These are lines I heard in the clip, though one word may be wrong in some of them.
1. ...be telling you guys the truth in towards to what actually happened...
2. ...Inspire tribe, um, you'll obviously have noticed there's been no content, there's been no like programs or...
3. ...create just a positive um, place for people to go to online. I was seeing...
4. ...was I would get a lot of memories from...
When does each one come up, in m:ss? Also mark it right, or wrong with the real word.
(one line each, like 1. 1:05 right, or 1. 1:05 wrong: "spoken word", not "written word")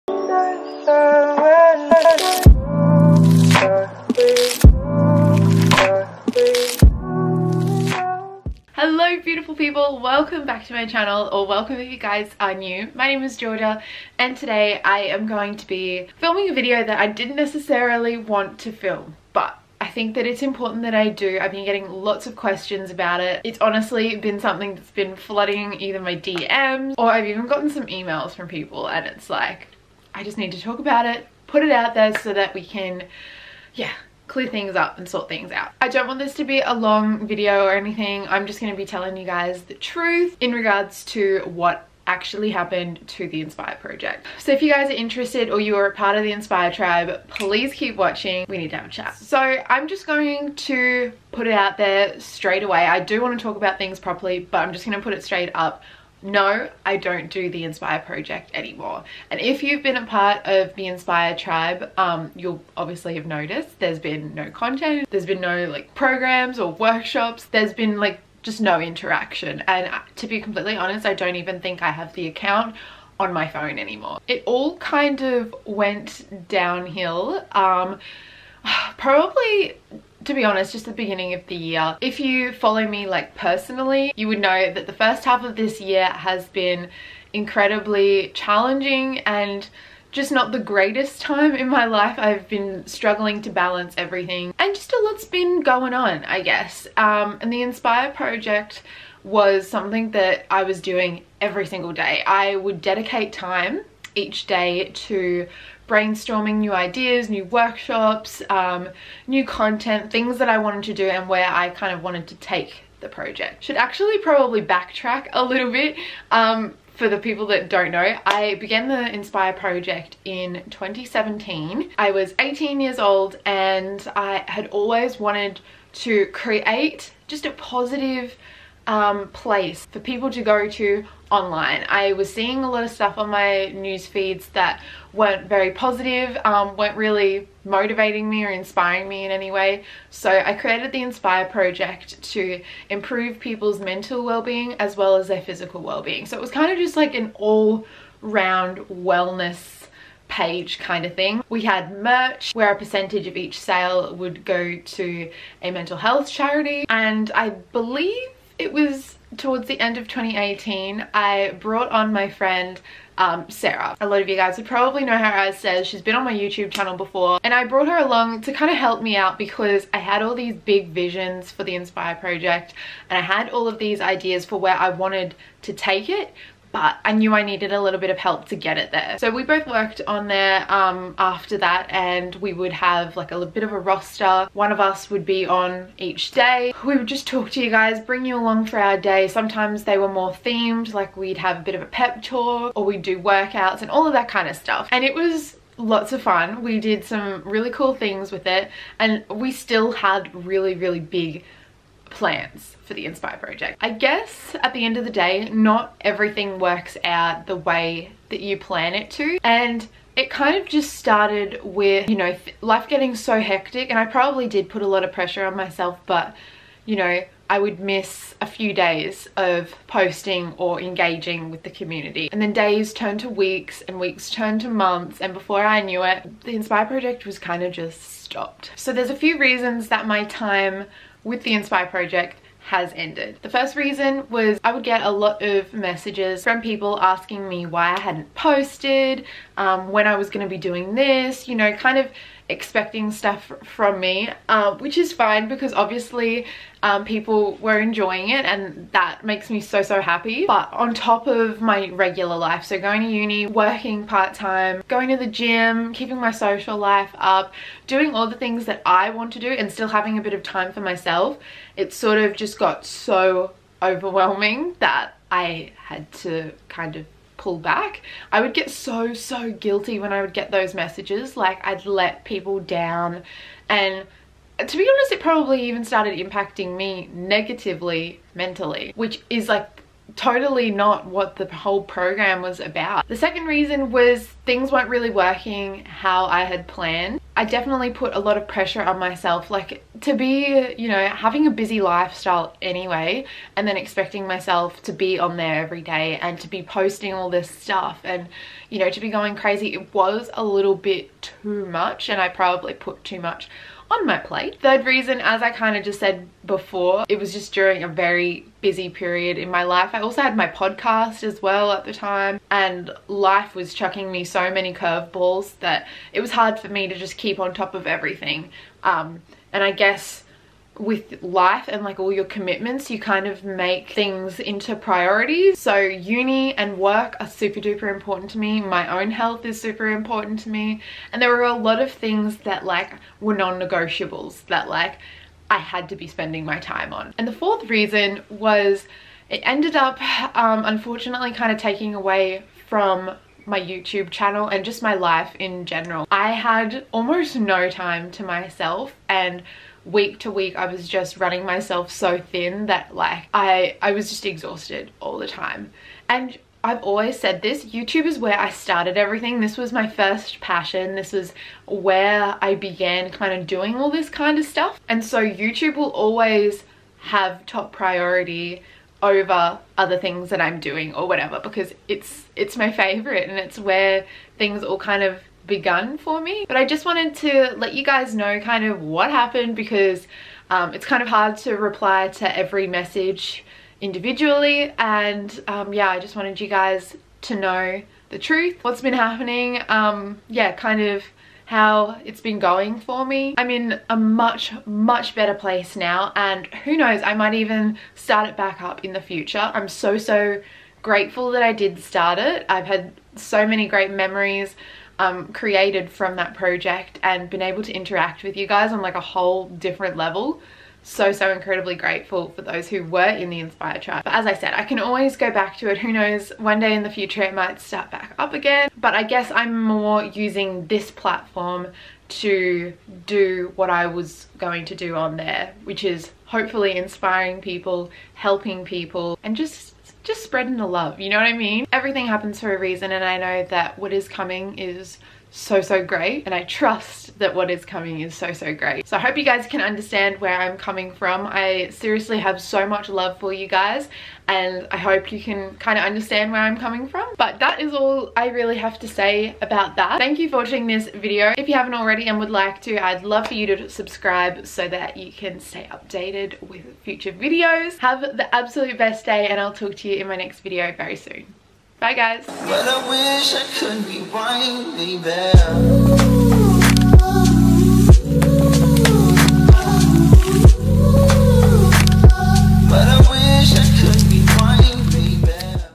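1. 0:38 wrong: "regards", not "towards"
2. 1:00 right
3. 2:06 right
4. 3:54 wrong: "messages", not "memories".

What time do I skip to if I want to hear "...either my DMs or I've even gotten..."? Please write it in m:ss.
0:25.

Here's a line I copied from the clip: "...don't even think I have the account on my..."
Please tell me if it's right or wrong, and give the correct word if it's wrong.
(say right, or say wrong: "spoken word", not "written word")
right.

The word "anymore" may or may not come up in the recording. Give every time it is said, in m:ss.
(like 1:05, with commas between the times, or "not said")
0:58, 1:13.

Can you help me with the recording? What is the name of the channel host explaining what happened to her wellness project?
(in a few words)
Georgia.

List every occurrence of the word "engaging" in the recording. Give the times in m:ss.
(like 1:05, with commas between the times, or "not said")
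3:40.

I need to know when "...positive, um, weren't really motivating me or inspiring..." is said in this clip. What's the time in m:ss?
2:15.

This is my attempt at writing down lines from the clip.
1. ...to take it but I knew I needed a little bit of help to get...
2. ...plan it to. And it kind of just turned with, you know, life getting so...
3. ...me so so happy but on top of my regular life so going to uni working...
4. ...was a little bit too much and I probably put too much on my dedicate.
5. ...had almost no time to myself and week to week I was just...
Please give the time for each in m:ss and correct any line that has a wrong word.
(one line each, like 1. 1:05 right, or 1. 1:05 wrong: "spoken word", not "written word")
1. 2:55 right
2. 3:28 wrong: "started", not "turned"
3. 4:09 right
4. 4:59 wrong: "plate", not "dedicate"
5. 5:46 right.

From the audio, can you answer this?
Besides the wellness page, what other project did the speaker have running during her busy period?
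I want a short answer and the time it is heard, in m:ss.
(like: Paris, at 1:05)
podcast, at 5:10.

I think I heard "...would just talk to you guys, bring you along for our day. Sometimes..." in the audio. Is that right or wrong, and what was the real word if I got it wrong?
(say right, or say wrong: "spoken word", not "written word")
right.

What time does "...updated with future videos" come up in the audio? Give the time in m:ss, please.
7:35.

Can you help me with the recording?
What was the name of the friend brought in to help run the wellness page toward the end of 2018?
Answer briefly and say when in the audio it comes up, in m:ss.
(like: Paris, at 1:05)
Sarah, at 2:43.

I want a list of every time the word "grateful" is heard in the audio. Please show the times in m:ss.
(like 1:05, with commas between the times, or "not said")
6:40, 6:51.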